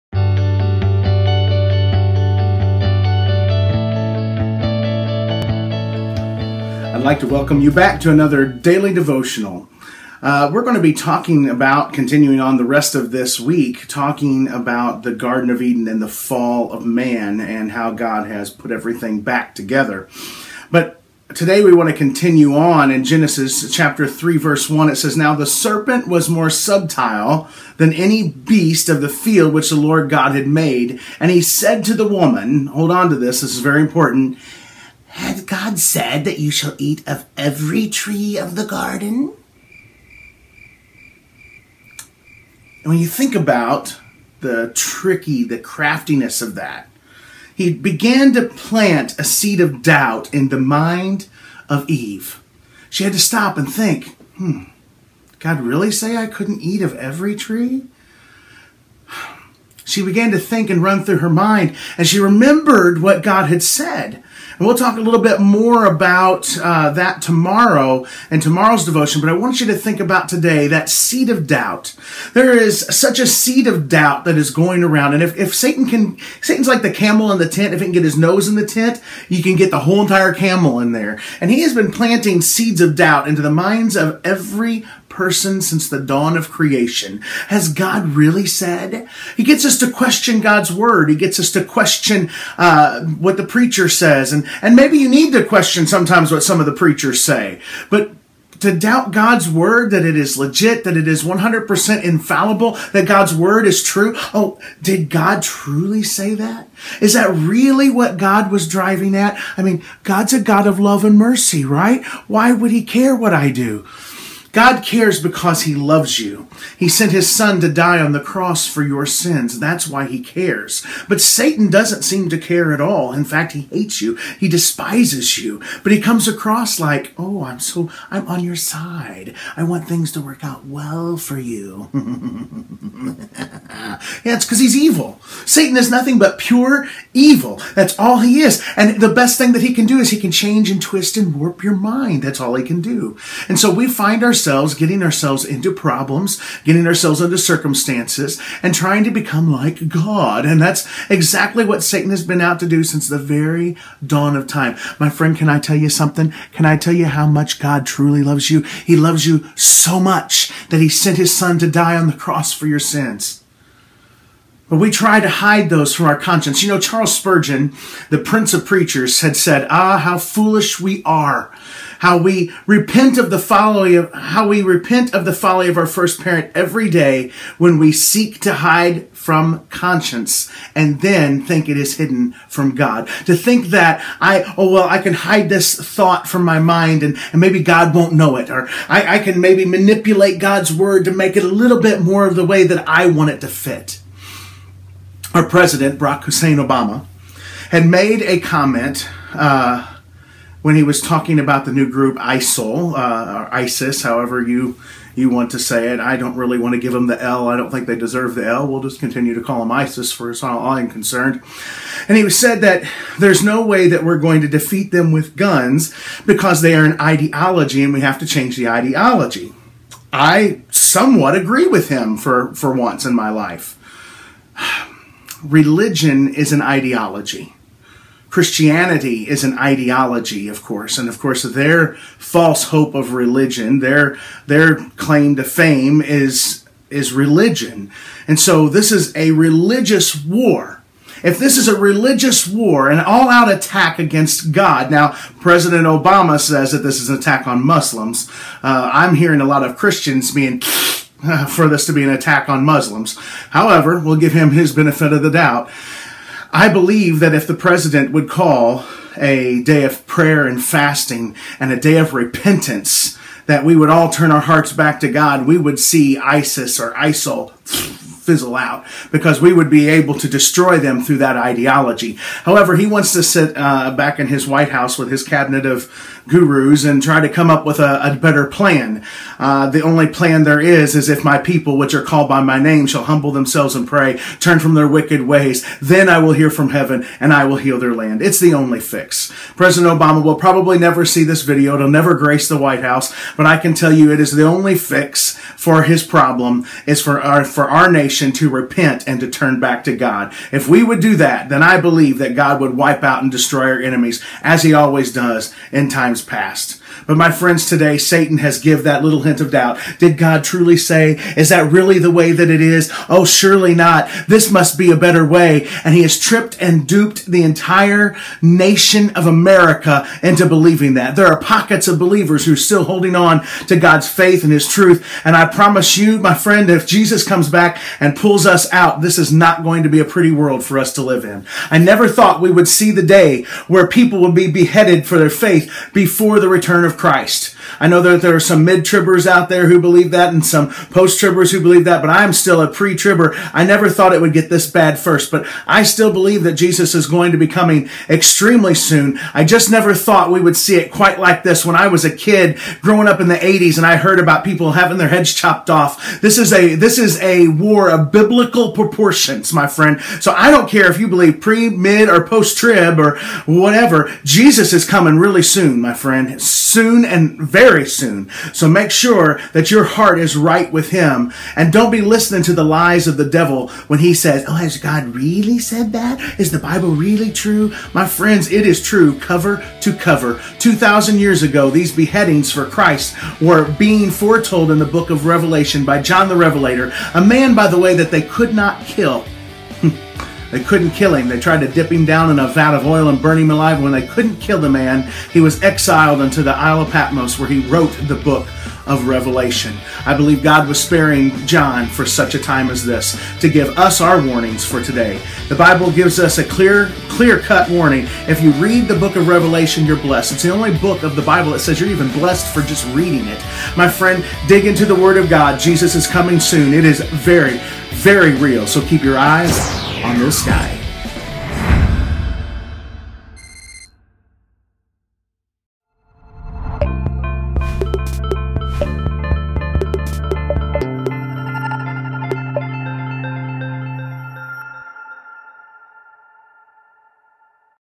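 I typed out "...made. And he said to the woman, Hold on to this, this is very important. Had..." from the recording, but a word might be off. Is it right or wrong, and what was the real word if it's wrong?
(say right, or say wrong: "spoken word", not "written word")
right.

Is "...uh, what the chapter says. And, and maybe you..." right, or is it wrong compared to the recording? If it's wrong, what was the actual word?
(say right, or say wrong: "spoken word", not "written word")
wrong: "preacher", not "chapter".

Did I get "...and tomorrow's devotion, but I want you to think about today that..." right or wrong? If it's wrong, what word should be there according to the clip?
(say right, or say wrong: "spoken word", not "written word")
right.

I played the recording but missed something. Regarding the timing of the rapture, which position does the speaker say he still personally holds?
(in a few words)
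Pre-tribber.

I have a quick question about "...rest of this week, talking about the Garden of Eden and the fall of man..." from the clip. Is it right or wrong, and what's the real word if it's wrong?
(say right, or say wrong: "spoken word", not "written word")
right.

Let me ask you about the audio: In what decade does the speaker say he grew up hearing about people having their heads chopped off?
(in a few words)
The 80s.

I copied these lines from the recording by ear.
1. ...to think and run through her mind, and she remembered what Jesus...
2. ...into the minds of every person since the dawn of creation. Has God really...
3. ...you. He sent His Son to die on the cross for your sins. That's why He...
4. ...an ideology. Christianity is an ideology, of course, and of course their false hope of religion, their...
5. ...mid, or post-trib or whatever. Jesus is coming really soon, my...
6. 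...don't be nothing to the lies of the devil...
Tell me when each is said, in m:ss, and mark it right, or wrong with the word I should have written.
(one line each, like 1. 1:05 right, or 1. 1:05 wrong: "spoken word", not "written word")
1. 1:00 wrong: "God", not "Jesus"
2. 1:23 right
3. 1:56 right
4. 3:46 right
5. 6:01 right
6. 6:11 wrong: "listening", not "nothing".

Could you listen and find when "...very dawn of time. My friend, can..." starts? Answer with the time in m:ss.
2:33.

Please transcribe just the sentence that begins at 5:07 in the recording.
But my friends, today Satan has give that little hint of doubt.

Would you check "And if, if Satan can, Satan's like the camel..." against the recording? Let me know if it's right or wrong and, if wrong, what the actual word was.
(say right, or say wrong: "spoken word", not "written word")
right.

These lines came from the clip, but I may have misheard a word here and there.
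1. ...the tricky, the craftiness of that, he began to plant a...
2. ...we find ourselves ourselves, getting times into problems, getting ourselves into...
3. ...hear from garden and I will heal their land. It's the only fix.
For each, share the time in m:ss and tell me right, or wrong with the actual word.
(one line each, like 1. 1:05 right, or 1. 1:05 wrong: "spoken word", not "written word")
1. 0:44 right
2. 2:23 wrong: "ourselves", not "times"
3. 4:46 wrong: "heaven", not "garden".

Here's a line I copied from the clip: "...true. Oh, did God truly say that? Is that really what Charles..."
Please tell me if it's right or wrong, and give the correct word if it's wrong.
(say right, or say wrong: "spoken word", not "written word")
wrong: "God", not "Charles".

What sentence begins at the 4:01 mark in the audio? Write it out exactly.
If this is a religious war, an all-out attack against God, now President Obama says that this is an attack on Muslims.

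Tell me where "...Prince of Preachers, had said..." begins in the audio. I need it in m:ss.
2:48.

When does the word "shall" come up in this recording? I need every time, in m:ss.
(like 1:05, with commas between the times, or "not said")
0:36, 4:42.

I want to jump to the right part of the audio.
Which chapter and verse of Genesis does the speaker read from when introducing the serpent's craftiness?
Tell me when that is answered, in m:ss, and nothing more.
0:23.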